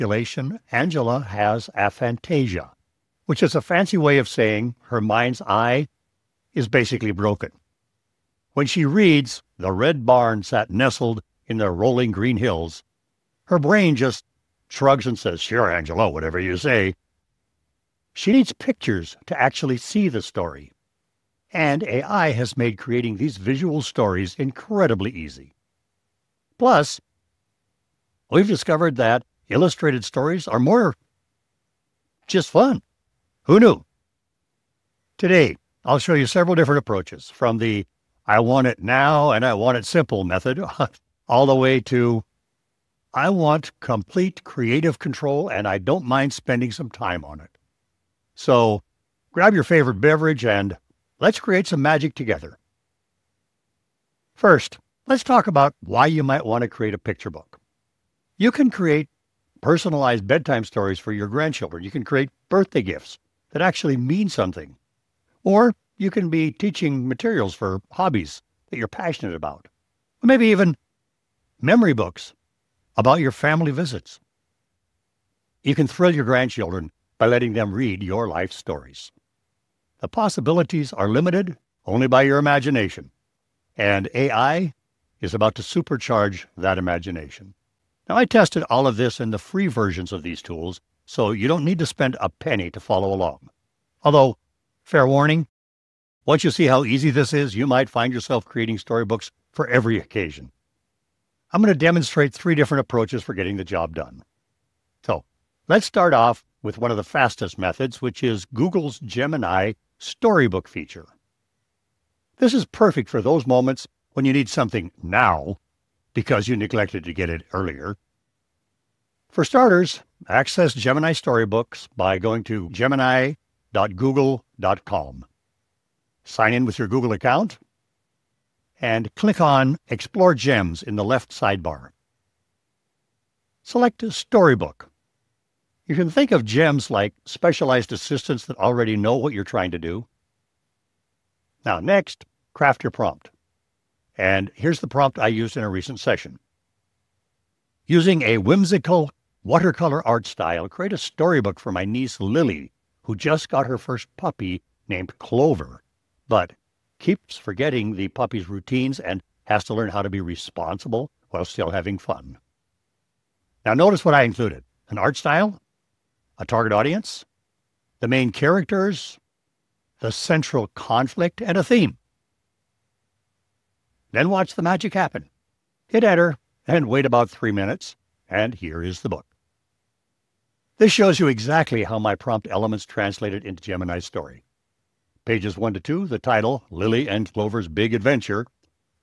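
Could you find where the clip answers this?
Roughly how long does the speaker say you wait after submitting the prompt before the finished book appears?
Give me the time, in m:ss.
2:57.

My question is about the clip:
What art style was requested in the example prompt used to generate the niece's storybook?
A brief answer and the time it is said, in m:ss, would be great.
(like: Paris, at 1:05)
Whimsical watercolor, at 2:28.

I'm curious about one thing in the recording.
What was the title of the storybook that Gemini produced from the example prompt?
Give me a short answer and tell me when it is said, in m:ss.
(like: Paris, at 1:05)
Lily and Clover's Big Adventure, at 3:06.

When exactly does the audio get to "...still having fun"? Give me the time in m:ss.
2:41.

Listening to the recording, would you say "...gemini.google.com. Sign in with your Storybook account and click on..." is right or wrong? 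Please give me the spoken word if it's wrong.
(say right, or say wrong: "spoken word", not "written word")
wrong: "Google", not "Storybook".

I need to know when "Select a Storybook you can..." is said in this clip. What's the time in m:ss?
2:13.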